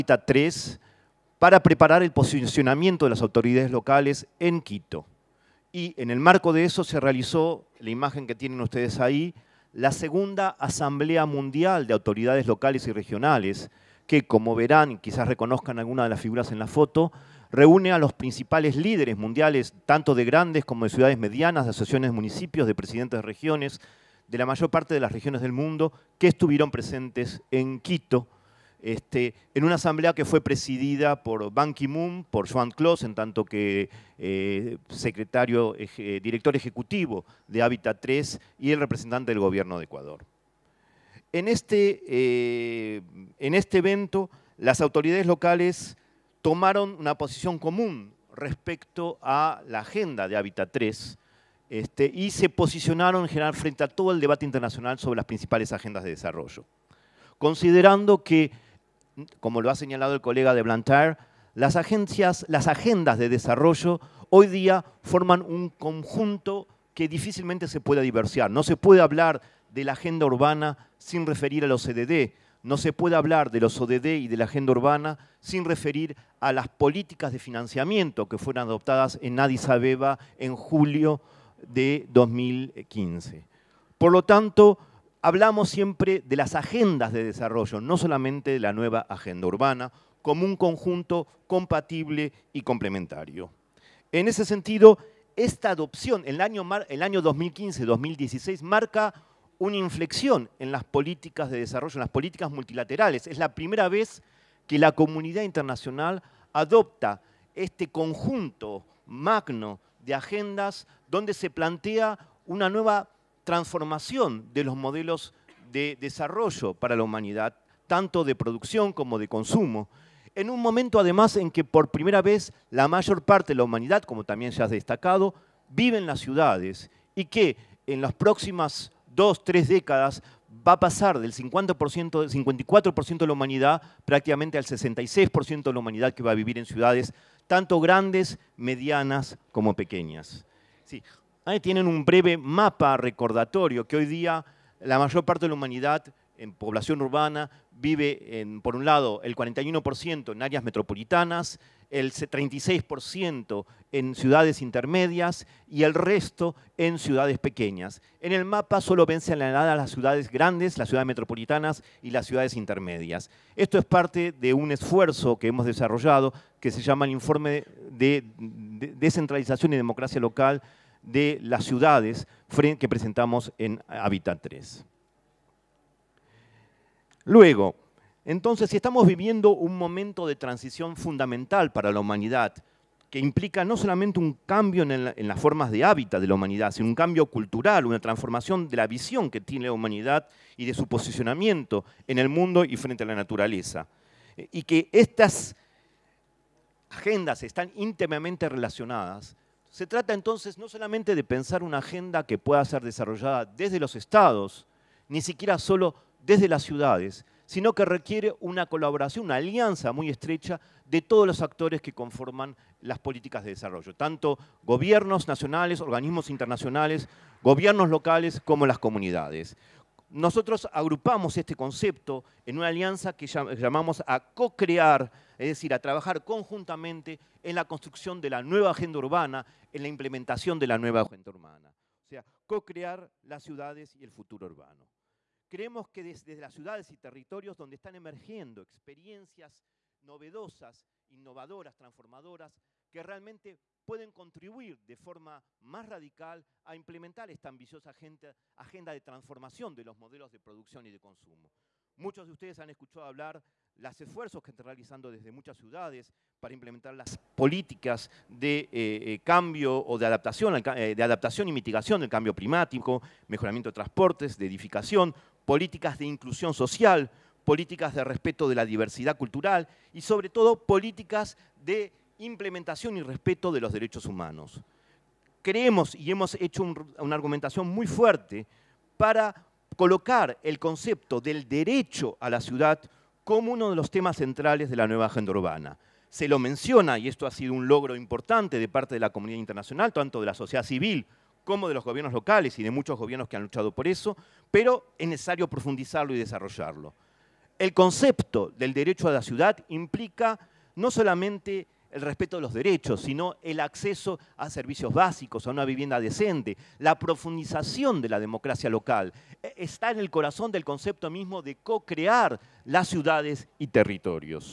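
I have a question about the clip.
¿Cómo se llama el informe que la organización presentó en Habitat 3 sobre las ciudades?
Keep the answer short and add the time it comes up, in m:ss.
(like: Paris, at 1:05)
Informe de Descentralización y Democracia Local, at 2:47.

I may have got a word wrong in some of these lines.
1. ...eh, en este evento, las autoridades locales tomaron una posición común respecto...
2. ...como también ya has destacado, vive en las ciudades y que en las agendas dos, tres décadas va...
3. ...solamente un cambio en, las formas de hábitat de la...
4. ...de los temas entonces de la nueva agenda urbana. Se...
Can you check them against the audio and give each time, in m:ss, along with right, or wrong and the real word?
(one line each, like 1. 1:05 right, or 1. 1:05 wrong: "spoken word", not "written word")
1. 0:42 right
2. 2:04 wrong: "próximas", not "agendas"
3. 3:03 right
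4. 4:43 wrong: "centrales", not "entonces".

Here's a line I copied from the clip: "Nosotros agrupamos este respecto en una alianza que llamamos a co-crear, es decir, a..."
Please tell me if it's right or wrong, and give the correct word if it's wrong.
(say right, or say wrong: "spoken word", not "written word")
wrong: "concepto", not "respecto".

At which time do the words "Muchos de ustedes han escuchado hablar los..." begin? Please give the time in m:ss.
4:11.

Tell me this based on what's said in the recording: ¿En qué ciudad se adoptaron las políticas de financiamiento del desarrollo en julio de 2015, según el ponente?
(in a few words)
Addis Abeba.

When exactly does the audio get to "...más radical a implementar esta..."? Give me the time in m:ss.
4:05.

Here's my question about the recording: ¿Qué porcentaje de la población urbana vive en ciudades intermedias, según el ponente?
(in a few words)
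36%.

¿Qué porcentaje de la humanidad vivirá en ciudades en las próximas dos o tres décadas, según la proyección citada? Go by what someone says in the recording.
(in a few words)
66%.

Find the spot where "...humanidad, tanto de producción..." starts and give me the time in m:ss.
1:57.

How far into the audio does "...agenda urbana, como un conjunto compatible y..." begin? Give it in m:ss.
1:29.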